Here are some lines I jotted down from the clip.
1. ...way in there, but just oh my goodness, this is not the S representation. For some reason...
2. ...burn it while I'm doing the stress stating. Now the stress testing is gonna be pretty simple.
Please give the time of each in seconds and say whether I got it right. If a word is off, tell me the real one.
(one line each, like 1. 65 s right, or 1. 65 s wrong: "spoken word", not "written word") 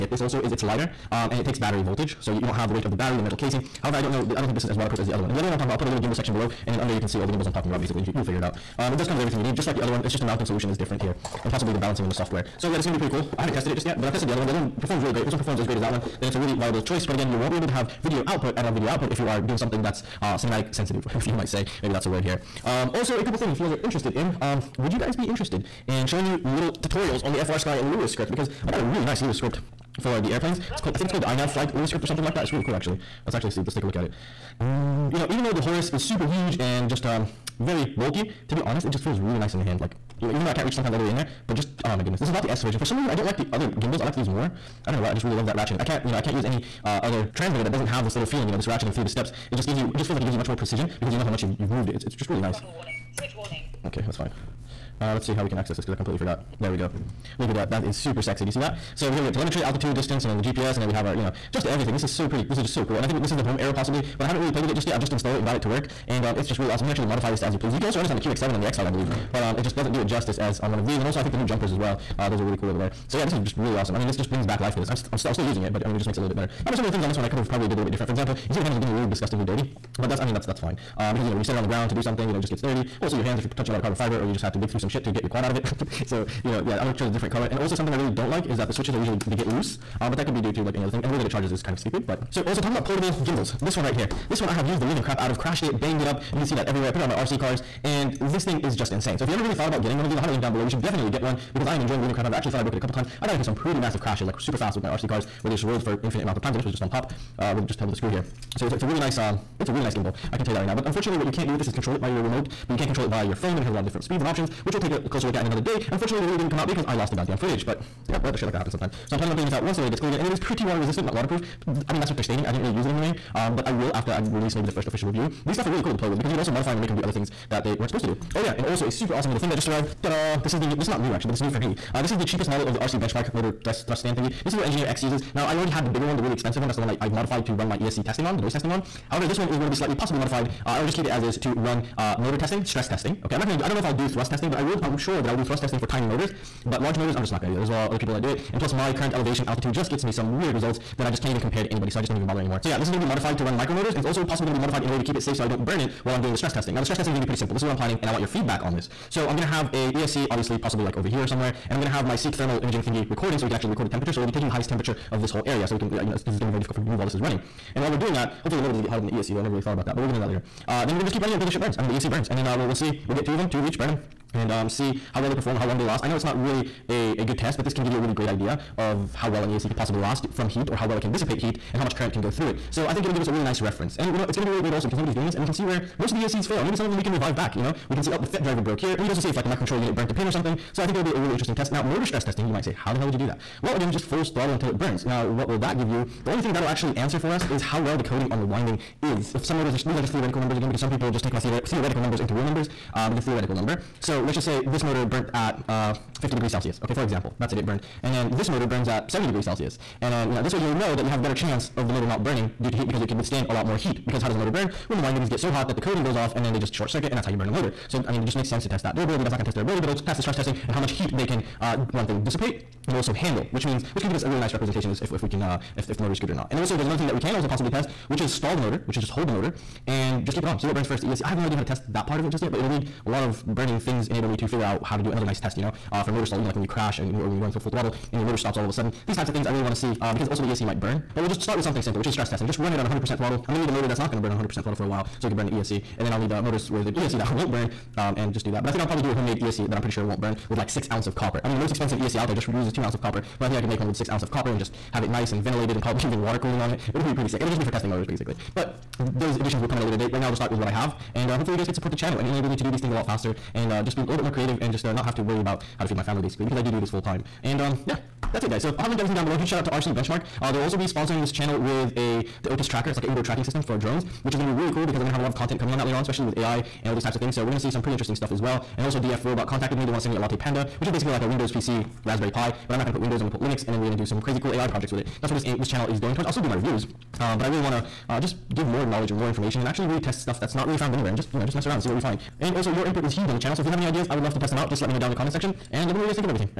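1. 41 s wrong: "version", not "representation"
2. 155 s wrong: "testing", not "stating".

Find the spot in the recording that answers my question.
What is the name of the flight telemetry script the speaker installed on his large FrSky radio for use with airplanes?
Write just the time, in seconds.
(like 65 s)
31 s.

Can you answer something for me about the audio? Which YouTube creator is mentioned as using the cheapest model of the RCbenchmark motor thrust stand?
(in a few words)
Engineer X.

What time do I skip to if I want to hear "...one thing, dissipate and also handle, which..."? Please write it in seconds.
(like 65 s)
221 s.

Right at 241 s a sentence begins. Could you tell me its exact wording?
But we'll just start with something simple, which is stress testing.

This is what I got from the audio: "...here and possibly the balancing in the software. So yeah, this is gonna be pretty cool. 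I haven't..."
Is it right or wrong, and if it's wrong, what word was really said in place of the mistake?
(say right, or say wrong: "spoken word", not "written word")
right.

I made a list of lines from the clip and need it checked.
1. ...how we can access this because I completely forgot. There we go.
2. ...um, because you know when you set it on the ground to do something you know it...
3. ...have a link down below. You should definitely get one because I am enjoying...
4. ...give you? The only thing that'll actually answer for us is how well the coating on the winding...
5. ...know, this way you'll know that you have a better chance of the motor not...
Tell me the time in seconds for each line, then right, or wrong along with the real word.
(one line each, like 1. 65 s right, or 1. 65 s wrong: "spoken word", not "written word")
1. 55 s right
2. 80 s right
3. 100 s right
4. 195 s right
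5. 210 s right.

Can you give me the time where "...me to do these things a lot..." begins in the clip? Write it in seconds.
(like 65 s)
262 s.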